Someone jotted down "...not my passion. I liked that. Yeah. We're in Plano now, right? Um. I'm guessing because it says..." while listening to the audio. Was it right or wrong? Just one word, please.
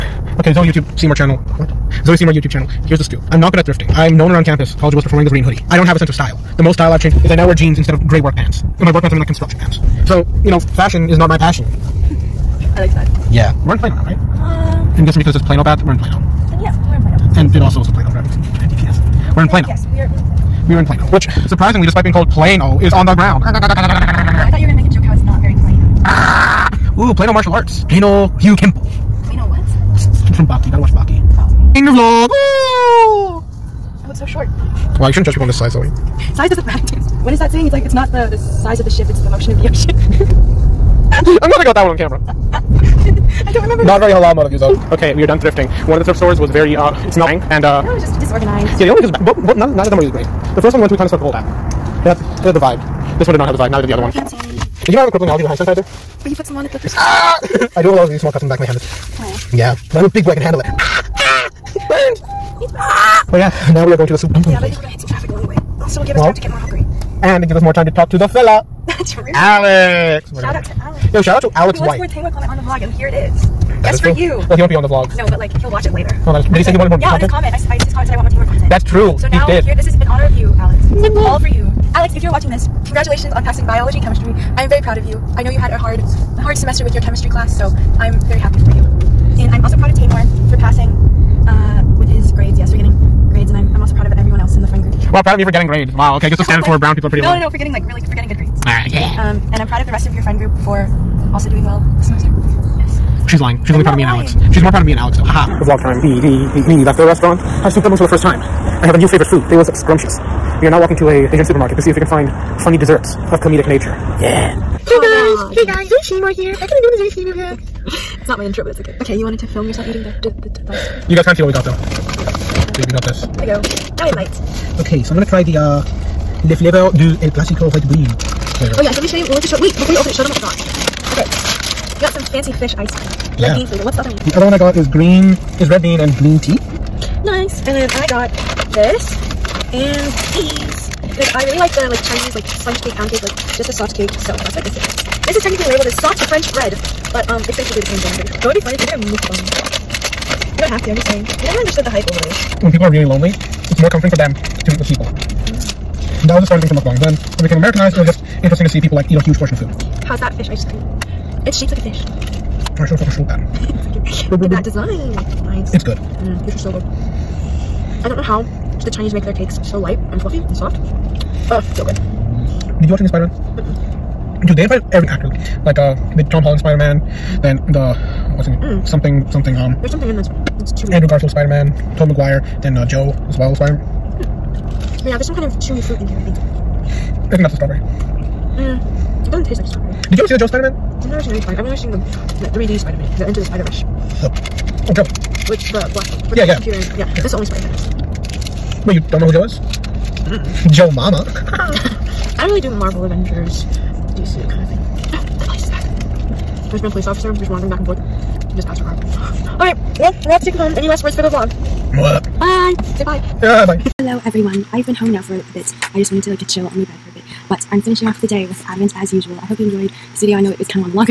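right.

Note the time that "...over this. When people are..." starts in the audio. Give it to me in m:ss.
2:32.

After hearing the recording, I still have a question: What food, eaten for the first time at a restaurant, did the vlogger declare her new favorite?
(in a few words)
Soup dumplings.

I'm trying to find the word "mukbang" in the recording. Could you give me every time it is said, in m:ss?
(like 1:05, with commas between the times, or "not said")
2:28, 2:36.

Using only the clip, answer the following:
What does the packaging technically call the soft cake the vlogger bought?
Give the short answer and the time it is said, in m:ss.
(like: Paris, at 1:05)
Soft French bread, at 2:25.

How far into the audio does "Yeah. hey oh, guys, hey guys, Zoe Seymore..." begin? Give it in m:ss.
1:54.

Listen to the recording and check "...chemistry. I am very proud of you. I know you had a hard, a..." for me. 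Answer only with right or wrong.
right.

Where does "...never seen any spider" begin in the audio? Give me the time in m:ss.
3:11.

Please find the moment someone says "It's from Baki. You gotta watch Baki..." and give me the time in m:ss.
0:30.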